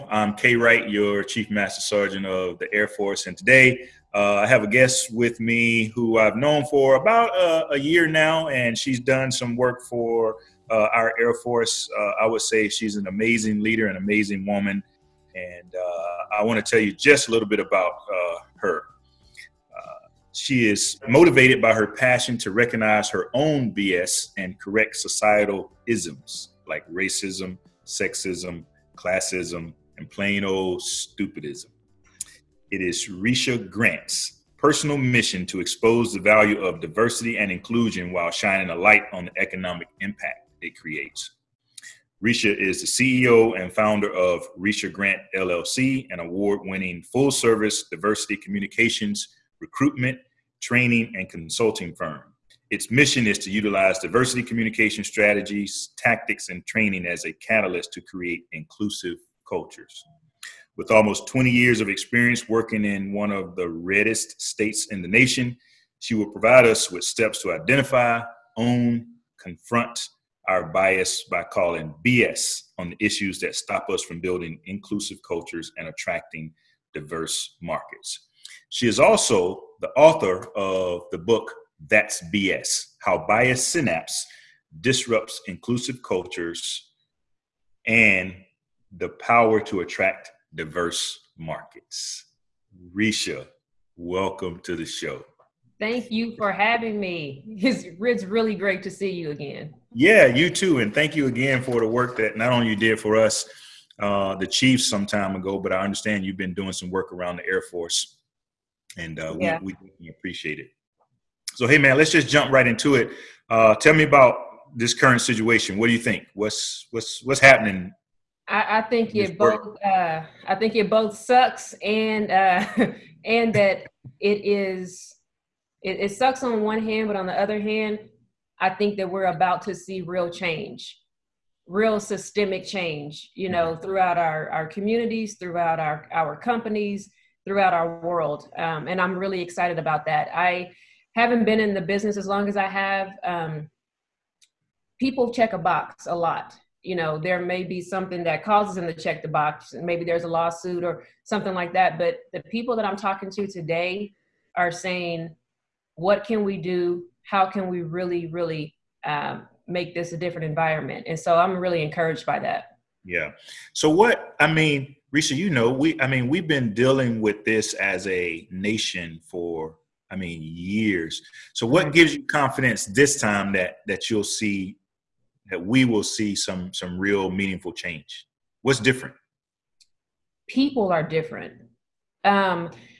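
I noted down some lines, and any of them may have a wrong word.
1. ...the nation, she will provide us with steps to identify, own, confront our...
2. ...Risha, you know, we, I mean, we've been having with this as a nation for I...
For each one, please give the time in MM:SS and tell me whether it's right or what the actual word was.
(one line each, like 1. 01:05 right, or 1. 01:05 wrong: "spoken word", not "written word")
1. 01:05 right
2. 02:45 wrong: "dealing", not "having".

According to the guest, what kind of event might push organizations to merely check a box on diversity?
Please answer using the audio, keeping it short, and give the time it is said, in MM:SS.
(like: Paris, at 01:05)
A lawsuit, at 02:30.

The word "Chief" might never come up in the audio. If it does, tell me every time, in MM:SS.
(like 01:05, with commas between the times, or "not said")
00:01, 01:44.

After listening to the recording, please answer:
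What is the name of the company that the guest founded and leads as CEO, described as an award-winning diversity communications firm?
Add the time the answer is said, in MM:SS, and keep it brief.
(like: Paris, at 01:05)
Risha Grant LLC, at 00:44.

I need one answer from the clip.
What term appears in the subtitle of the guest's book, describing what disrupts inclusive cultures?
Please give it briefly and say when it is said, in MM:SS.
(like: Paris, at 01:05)
Bias synapse, at 01:23.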